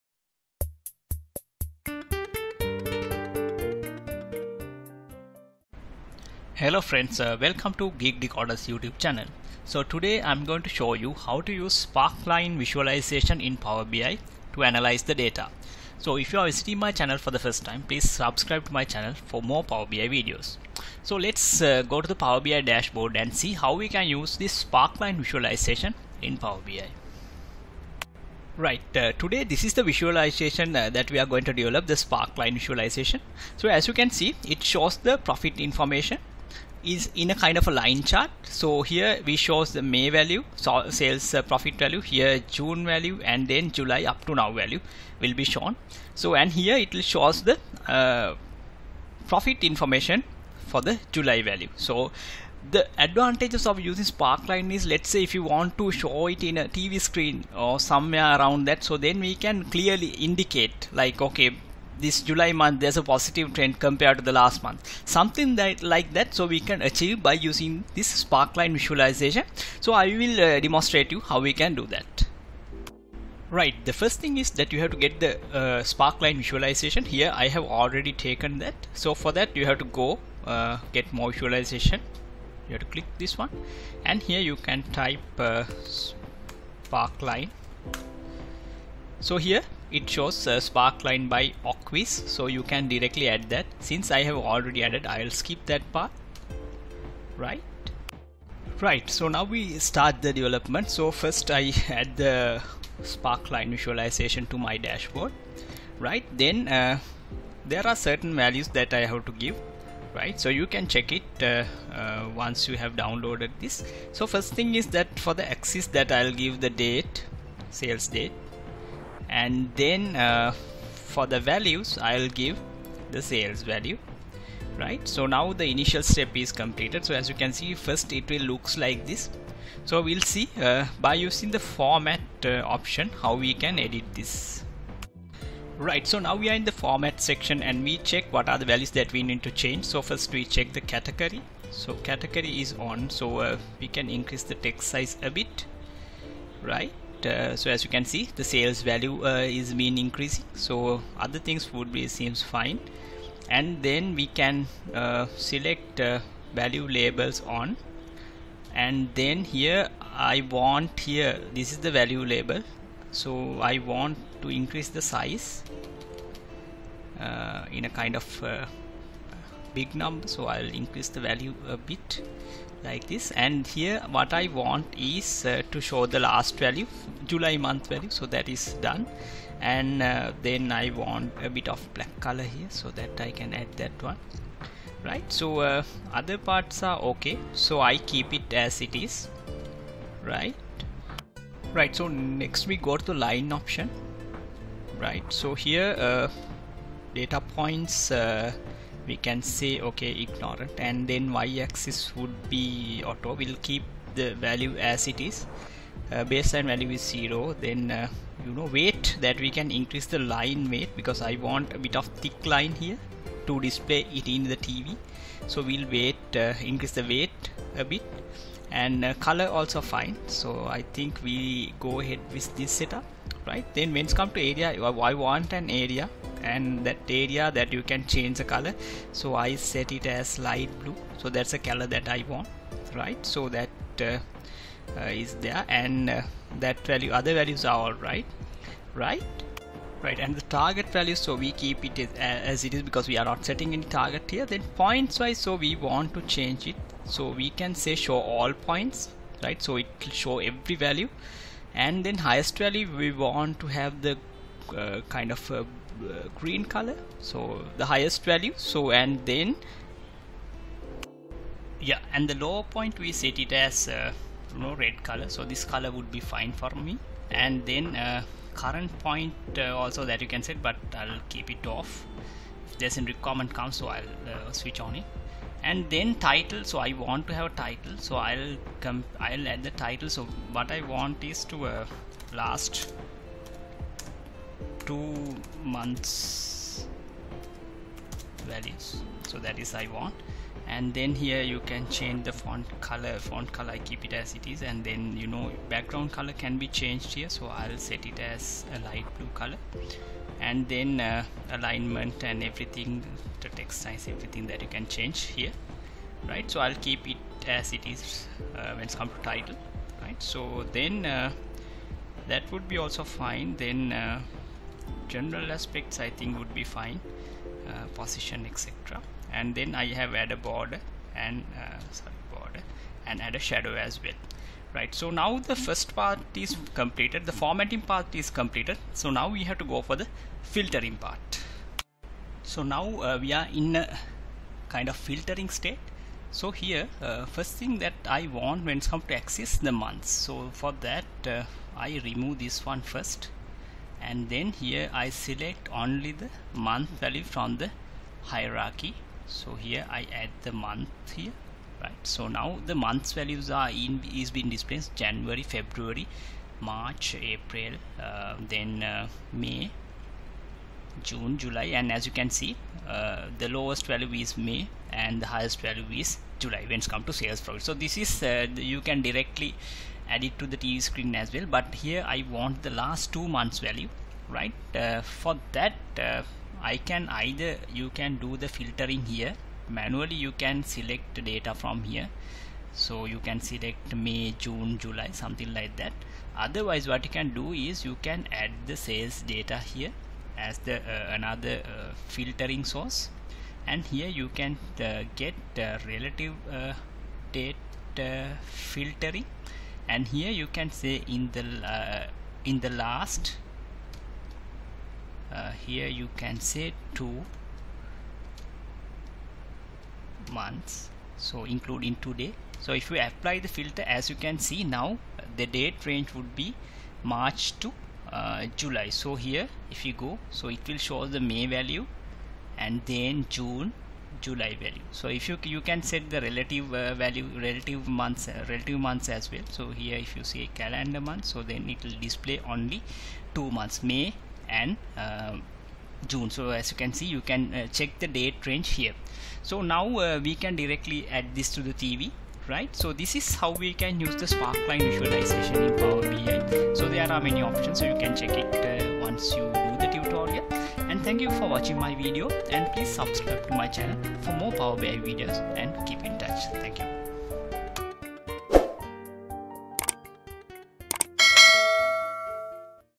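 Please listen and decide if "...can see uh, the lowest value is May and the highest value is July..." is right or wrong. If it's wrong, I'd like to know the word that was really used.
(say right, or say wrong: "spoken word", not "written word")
right.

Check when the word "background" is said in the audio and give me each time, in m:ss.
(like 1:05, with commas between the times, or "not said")
4:55.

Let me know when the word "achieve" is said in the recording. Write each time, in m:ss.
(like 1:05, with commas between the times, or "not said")
1:06.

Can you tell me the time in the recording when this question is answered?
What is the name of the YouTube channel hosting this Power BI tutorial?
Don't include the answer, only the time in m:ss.
0:07.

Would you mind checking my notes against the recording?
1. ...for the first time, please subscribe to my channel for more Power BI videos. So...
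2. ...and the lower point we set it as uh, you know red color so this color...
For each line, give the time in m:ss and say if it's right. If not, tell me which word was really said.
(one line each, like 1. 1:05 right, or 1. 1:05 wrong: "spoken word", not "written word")
1. 0:17 right
2. 4:22 right.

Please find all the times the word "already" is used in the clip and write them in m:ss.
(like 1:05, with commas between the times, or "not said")
1:17, 1:34.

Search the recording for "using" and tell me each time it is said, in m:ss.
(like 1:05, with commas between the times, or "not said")
0:53, 1:07, 2:11.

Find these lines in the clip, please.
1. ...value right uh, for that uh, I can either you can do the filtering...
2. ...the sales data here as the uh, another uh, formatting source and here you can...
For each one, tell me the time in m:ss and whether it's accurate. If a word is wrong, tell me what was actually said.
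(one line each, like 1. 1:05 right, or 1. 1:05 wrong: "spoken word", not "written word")
1. 6:13 right
2. 6:28 wrong: "filtering", not "formatting".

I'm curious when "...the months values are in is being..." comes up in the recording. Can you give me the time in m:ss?
5:52.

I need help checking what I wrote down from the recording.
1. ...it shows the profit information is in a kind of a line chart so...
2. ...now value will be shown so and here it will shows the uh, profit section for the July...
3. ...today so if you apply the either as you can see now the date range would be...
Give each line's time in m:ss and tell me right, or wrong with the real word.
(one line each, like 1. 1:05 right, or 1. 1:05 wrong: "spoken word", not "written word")
1. 0:34 right
2. 0:44 wrong: "information", not "section"
3. 6:51 wrong: "filter", not "either".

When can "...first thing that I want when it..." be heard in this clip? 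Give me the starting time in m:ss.
5:37.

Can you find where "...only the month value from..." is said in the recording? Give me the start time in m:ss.
5:45.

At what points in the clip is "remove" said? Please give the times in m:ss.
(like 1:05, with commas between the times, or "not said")
5:42.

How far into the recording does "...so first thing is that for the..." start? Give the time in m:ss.
1:54.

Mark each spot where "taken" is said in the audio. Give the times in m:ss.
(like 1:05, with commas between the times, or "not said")
1:18.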